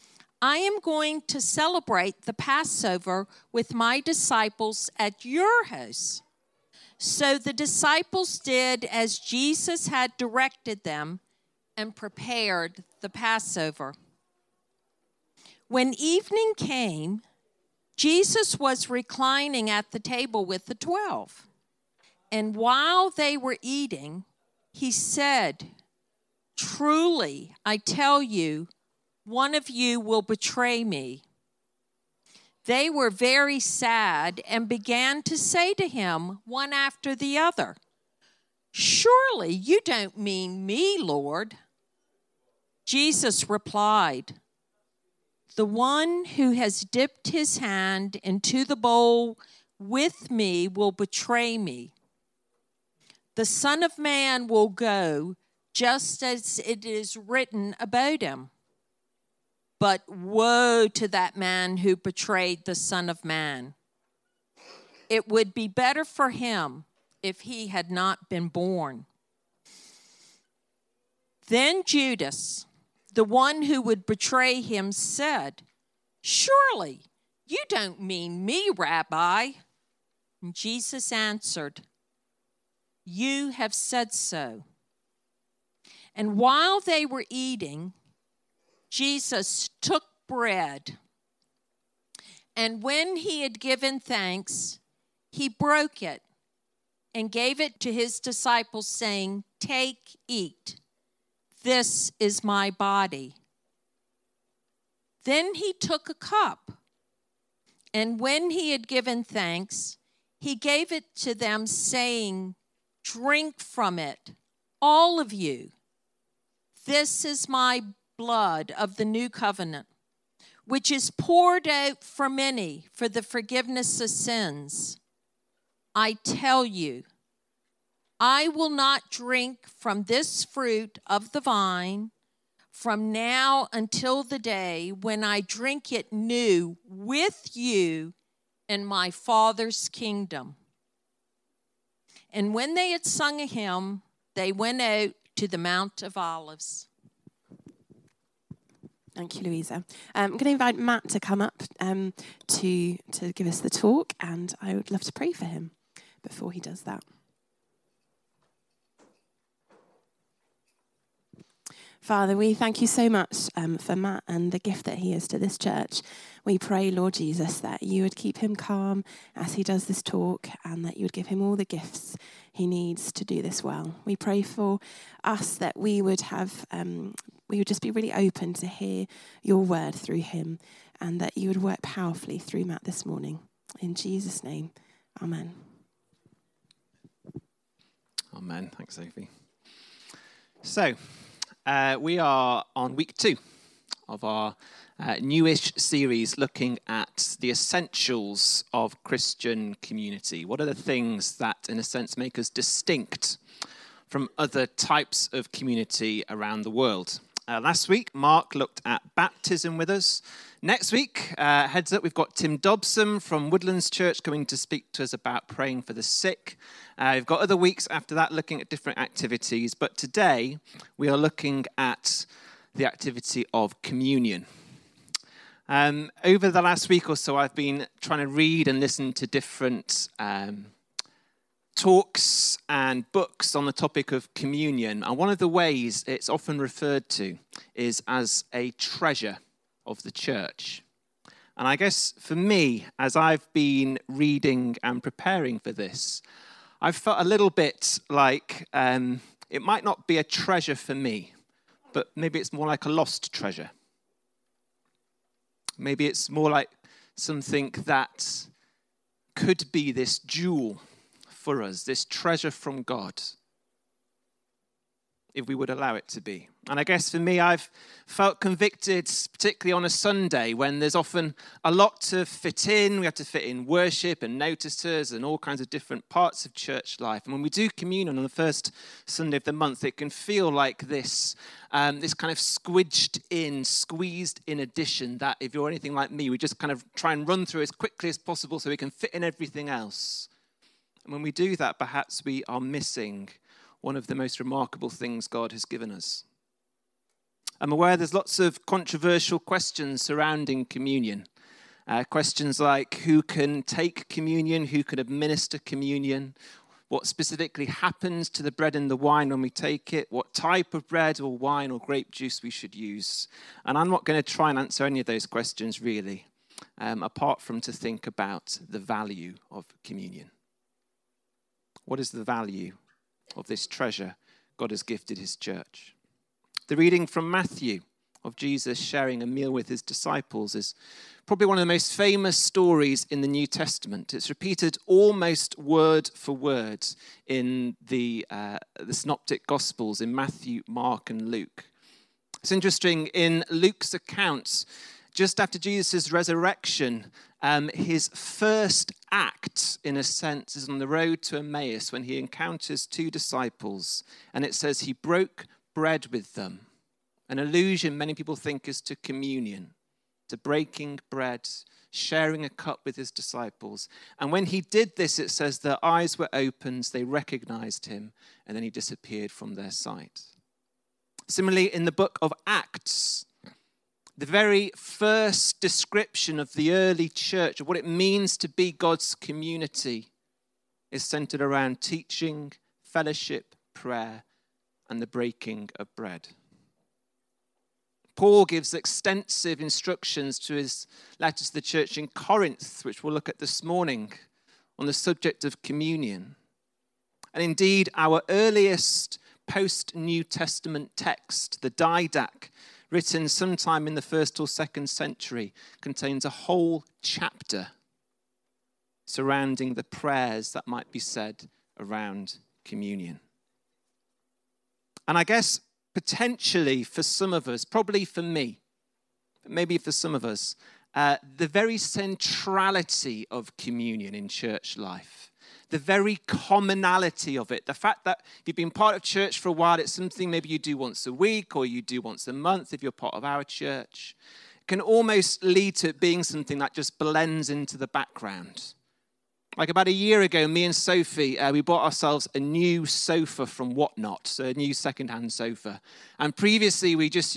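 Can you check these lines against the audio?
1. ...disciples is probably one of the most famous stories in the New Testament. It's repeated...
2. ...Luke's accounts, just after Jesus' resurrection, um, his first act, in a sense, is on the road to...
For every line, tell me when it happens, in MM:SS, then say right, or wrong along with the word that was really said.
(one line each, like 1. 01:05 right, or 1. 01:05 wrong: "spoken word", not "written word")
1. 05:29 right
2. 05:43 right.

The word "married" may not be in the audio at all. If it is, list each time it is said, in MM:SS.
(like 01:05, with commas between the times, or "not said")
not said.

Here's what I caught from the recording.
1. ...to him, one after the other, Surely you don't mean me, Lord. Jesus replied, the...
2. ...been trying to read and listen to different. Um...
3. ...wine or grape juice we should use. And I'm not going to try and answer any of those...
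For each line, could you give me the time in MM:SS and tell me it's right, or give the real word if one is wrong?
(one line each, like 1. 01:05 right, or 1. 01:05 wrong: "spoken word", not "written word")
1. 00:35 right
2. 03:47 right
3. 05:11 right.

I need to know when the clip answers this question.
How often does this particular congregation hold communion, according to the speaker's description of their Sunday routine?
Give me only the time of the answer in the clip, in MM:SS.
04:38.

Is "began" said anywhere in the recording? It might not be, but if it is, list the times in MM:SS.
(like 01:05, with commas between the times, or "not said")
00:34.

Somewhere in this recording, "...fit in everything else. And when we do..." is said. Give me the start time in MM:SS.
04:48.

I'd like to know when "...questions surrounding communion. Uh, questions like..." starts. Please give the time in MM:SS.
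04:59.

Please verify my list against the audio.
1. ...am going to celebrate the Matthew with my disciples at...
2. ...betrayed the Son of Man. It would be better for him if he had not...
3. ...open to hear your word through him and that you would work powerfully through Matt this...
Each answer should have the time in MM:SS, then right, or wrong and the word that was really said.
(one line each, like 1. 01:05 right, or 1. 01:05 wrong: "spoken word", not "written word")
1. 00:00 wrong: "Passover", not "Matthew"
2. 01:01 right
3. 02:58 right.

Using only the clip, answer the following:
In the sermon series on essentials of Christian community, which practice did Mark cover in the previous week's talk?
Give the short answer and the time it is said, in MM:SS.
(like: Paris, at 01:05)
Baptism, at 03:29.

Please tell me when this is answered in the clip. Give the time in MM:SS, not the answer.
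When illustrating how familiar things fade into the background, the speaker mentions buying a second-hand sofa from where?
07:23.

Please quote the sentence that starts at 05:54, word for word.
And it says he broke bread with them.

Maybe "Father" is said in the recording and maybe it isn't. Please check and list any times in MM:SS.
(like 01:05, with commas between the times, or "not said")
02:19, 02:42.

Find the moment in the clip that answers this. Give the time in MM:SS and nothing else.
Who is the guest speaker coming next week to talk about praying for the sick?
03:32.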